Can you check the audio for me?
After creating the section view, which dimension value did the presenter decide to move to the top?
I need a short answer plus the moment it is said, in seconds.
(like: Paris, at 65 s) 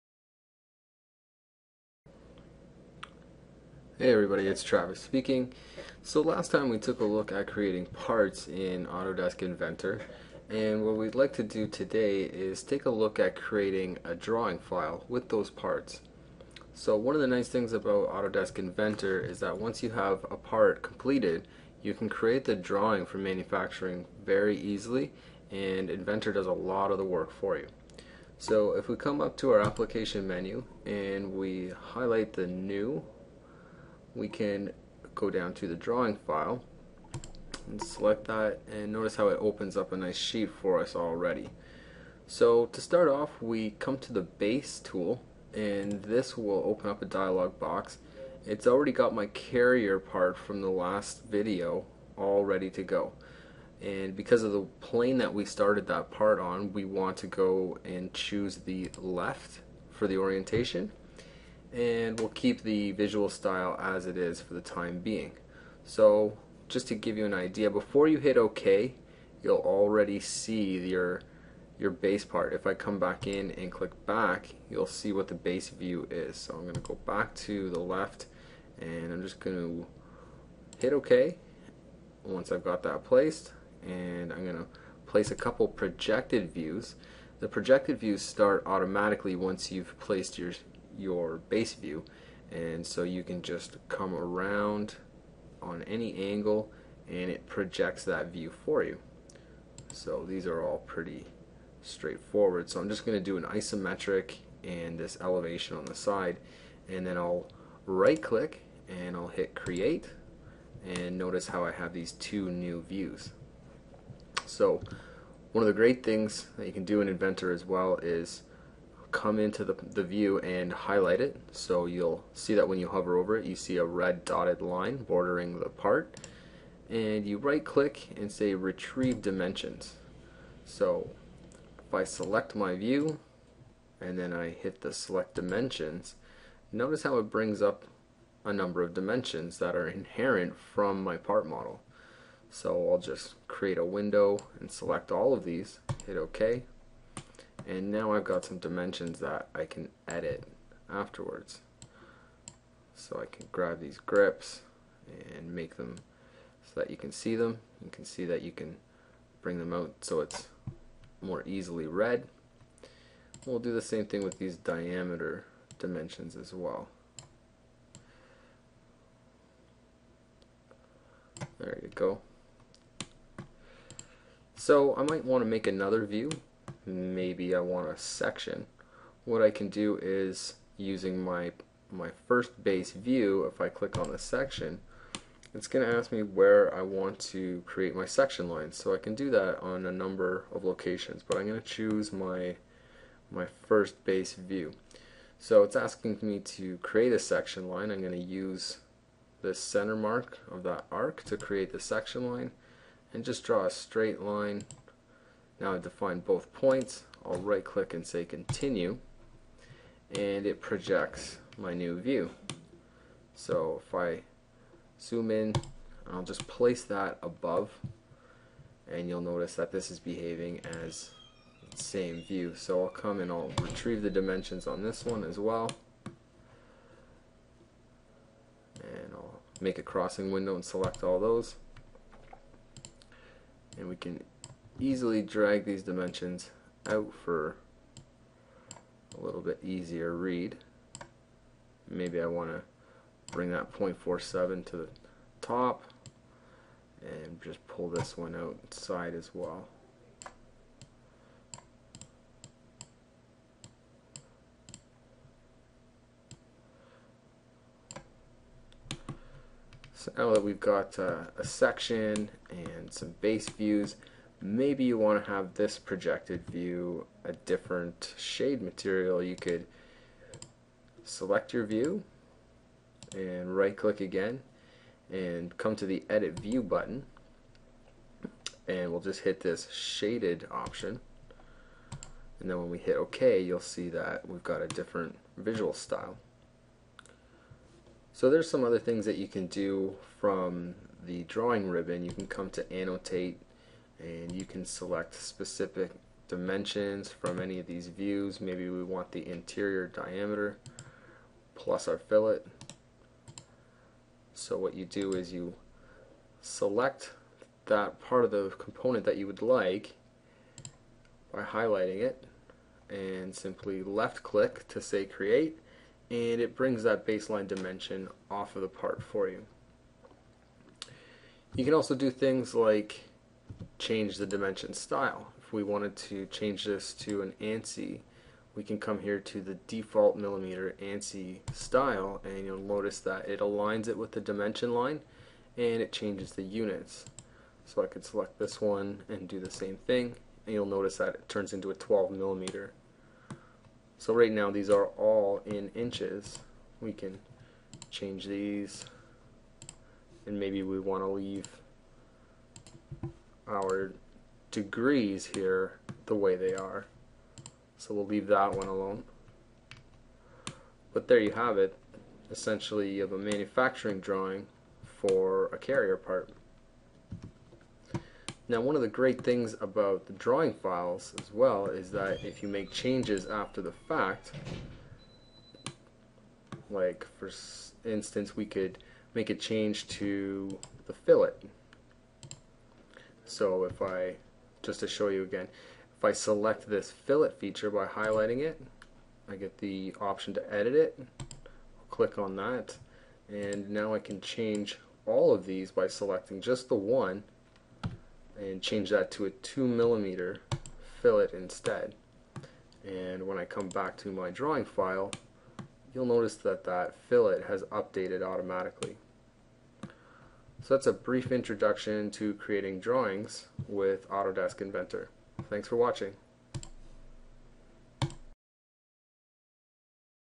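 0.47, at 243 s.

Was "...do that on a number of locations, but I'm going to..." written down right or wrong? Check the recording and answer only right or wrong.
right.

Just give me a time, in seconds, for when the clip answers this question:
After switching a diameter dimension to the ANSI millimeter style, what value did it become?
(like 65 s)
341 s.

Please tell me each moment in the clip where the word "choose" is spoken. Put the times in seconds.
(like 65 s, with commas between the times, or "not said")
58 s, 191 s.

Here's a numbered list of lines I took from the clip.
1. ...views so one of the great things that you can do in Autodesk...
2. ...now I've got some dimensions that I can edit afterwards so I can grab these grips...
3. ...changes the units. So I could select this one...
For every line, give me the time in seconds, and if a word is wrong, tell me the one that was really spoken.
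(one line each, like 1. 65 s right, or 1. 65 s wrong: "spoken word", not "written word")
1. 112 s wrong: "Inventor", not "Autodesk"
2. 147 s right
3. 335 s right.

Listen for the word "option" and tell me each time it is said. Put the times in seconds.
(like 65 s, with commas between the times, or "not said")
280 s, 390 s.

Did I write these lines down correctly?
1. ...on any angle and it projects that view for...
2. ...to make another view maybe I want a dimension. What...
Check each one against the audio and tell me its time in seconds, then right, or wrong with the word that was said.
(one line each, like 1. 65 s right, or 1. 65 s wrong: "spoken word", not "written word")
1. 95 s right
2. 175 s wrong: "section", not "dimension".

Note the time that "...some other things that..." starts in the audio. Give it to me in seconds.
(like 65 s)
288 s.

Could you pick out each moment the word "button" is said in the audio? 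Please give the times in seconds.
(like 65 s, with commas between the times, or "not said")
276 s.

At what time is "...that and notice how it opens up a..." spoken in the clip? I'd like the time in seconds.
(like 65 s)
38 s.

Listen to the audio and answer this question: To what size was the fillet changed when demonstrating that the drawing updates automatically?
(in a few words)
2 millimeters.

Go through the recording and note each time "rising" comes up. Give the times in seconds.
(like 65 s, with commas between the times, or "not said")
not said.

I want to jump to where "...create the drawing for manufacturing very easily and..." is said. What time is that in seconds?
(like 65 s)
22 s.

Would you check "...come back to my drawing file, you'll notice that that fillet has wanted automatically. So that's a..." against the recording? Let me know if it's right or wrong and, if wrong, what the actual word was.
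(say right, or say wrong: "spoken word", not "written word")
wrong: "updated", not "wanted".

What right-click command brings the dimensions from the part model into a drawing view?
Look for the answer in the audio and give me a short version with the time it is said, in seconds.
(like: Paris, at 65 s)
Retrieve dimensions, at 128 s.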